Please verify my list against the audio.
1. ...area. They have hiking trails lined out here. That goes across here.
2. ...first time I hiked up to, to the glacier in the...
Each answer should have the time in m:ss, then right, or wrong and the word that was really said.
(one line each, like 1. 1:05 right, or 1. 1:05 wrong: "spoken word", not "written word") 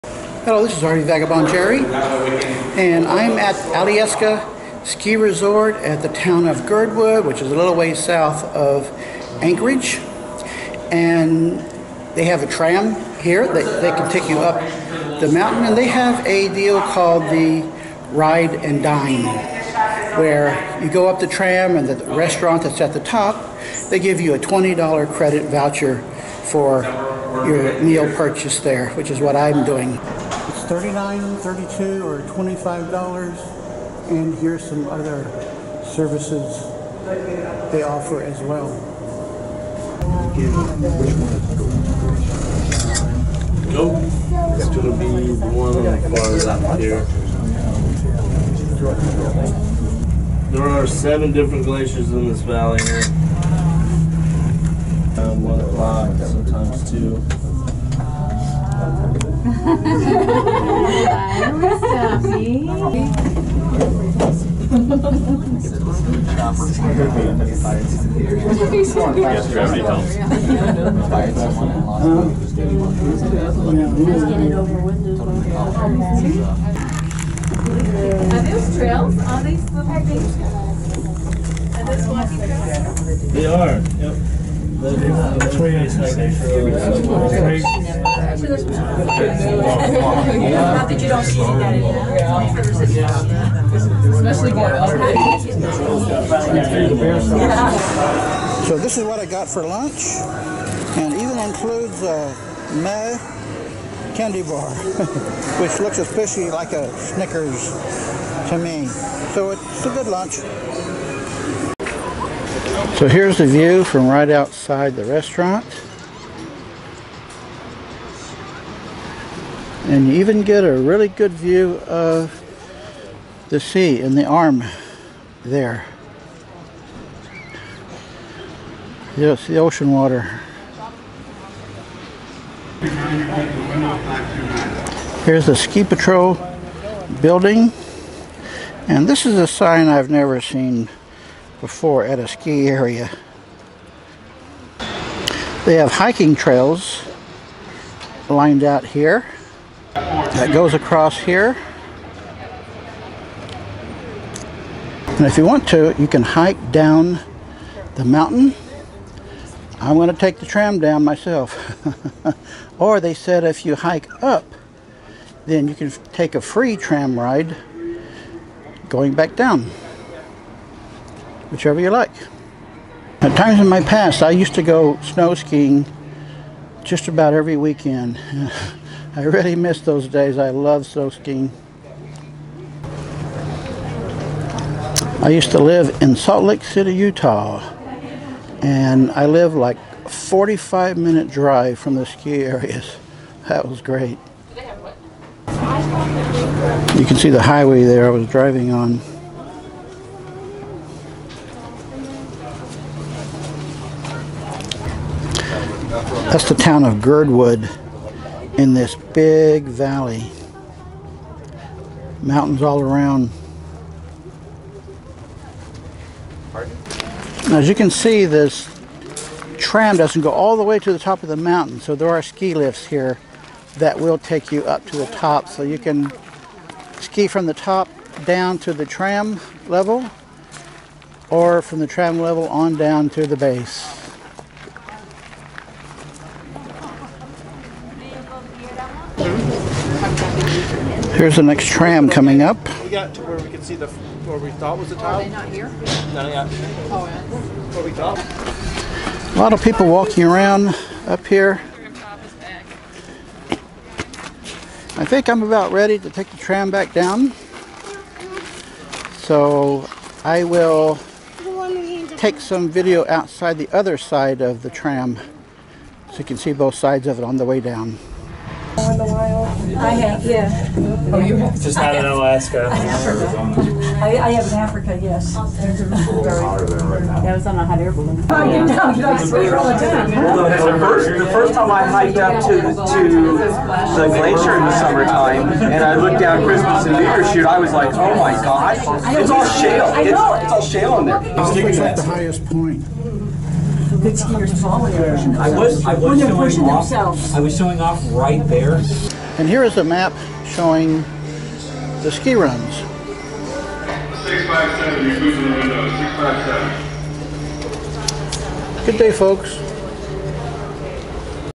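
1. 2:22 right
2. 4:41 right.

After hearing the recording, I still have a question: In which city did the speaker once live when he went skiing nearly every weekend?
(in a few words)
Salt Lake City.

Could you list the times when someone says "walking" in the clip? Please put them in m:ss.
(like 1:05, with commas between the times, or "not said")
1:22, 4:09.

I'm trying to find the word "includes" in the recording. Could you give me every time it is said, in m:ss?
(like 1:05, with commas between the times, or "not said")
1:41.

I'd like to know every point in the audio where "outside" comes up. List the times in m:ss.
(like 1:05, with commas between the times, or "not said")
1:54, 4:23.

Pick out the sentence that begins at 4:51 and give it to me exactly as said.
I was It's like the highest point good skiers falling.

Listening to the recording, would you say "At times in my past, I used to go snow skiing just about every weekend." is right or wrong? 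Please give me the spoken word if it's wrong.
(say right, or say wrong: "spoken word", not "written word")
right.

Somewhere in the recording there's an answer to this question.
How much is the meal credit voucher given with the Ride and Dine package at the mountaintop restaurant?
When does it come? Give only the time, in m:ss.
0:24.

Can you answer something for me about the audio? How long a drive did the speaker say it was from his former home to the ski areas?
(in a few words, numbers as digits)
45 minutes.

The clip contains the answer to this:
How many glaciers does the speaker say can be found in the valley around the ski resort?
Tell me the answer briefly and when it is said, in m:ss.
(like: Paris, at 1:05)
7, at 0:50.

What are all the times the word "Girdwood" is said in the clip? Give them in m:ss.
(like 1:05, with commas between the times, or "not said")
0:06, 3:27.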